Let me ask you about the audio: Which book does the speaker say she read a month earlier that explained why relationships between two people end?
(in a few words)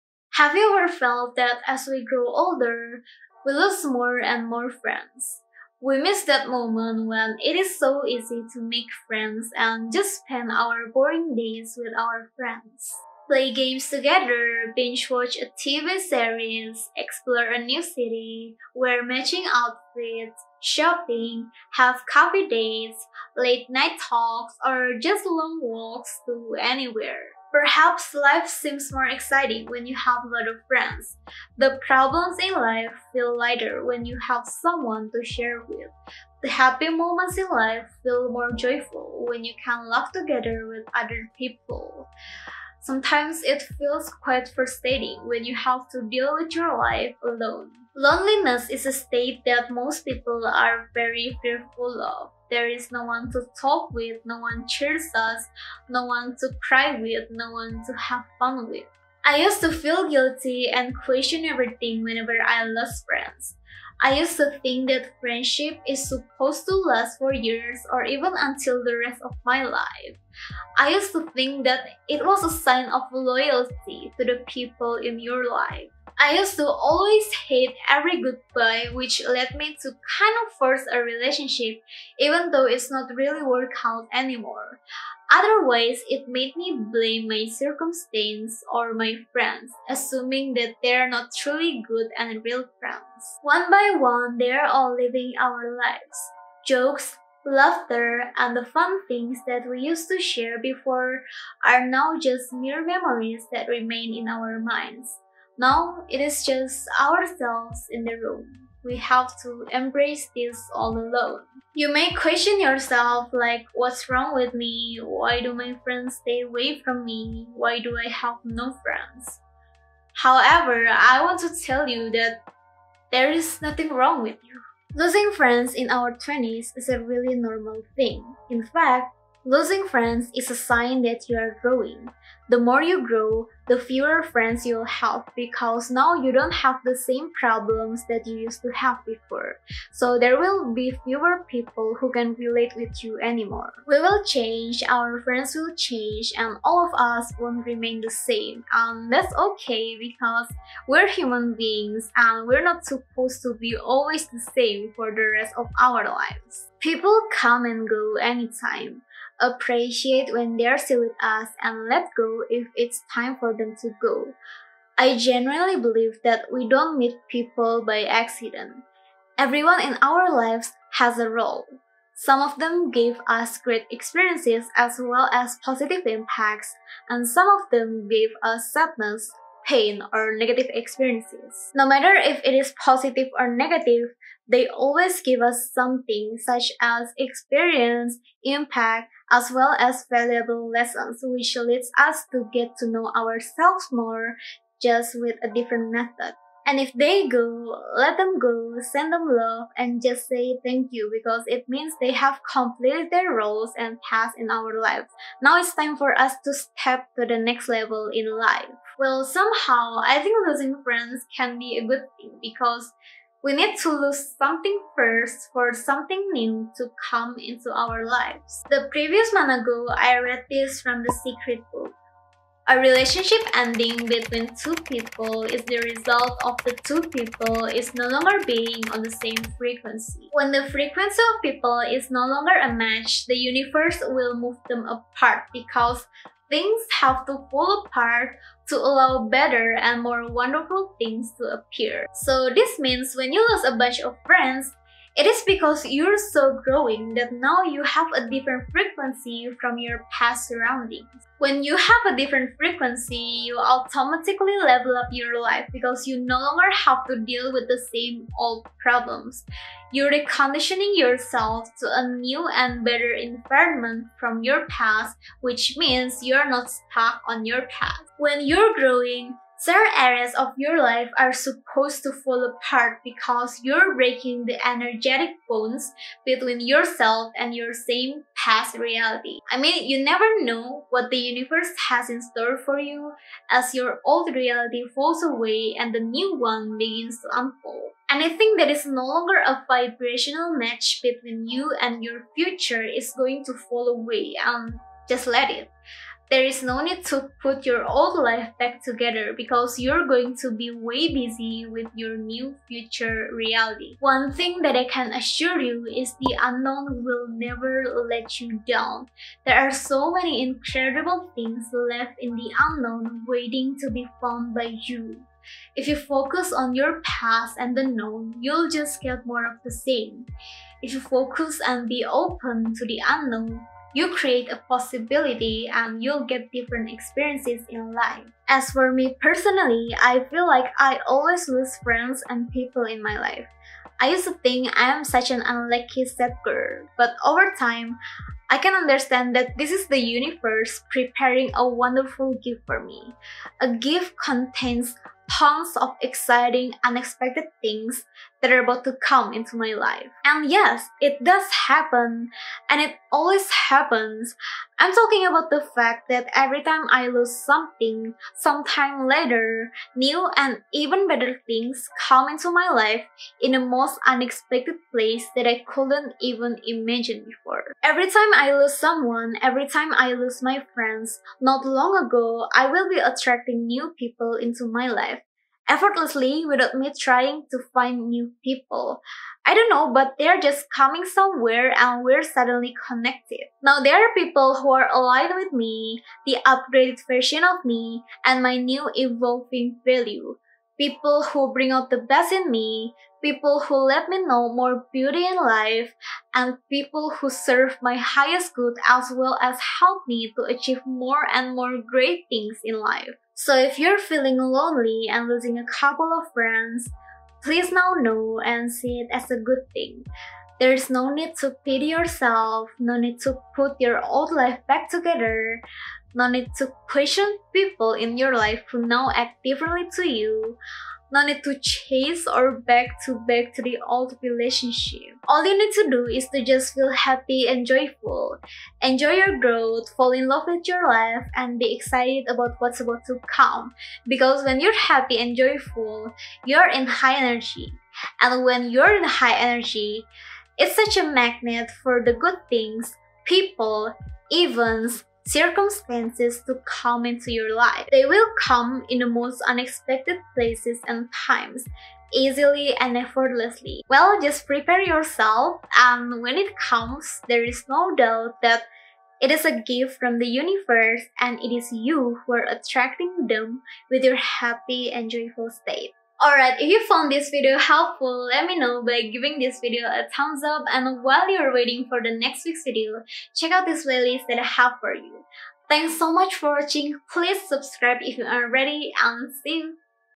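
The Secret.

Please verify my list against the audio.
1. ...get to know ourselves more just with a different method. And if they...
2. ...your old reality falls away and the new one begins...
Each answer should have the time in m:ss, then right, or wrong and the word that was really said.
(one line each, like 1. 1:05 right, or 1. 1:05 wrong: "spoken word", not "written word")
1. 3:12 right
2. 4:43 right.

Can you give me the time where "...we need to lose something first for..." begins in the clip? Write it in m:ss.
3:33.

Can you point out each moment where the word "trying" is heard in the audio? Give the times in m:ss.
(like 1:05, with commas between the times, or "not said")
6:16.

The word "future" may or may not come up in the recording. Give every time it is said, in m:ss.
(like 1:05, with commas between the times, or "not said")
4:52, 5:02.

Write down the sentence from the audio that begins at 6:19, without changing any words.
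I don't know, but they're just coming somewhere and we're suddenly connected.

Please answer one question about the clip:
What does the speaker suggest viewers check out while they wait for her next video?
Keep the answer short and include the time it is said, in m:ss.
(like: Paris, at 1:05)
playlist, at 7:53.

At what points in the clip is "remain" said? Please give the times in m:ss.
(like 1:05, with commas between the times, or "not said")
1:43, 2:27.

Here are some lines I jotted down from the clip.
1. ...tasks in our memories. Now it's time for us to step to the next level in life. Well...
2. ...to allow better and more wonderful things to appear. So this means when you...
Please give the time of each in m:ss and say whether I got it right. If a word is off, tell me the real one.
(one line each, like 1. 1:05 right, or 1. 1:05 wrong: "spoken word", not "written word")
1. 3:24 wrong: "lives", not "memories"
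2. 3:58 right.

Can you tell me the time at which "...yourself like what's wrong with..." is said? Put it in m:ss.
1:52.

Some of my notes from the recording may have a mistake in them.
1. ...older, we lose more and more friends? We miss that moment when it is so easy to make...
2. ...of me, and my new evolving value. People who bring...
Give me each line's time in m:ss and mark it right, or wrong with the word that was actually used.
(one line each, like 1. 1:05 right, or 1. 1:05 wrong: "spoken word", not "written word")
1. 0:02 right
2. 6:27 right.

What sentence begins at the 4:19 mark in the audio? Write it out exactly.
You're reconditioning yourself to a new and better environment from your past, which means you're not stuck on your past.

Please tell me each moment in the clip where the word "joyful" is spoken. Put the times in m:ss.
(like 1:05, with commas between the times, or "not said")
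0:38, 7:07, 7:15, 7:45.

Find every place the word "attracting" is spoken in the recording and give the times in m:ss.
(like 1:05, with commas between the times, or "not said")
6:12, 7:42.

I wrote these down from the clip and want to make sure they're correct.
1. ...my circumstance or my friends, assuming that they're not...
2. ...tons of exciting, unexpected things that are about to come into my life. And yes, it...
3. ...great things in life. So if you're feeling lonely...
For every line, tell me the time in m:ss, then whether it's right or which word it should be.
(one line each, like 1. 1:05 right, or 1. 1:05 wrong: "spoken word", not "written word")
1. 1:27 right
2. 5:45 right
3. 6:41 right.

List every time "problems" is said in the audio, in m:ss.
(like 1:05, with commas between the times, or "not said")
0:31, 2:17, 4:18.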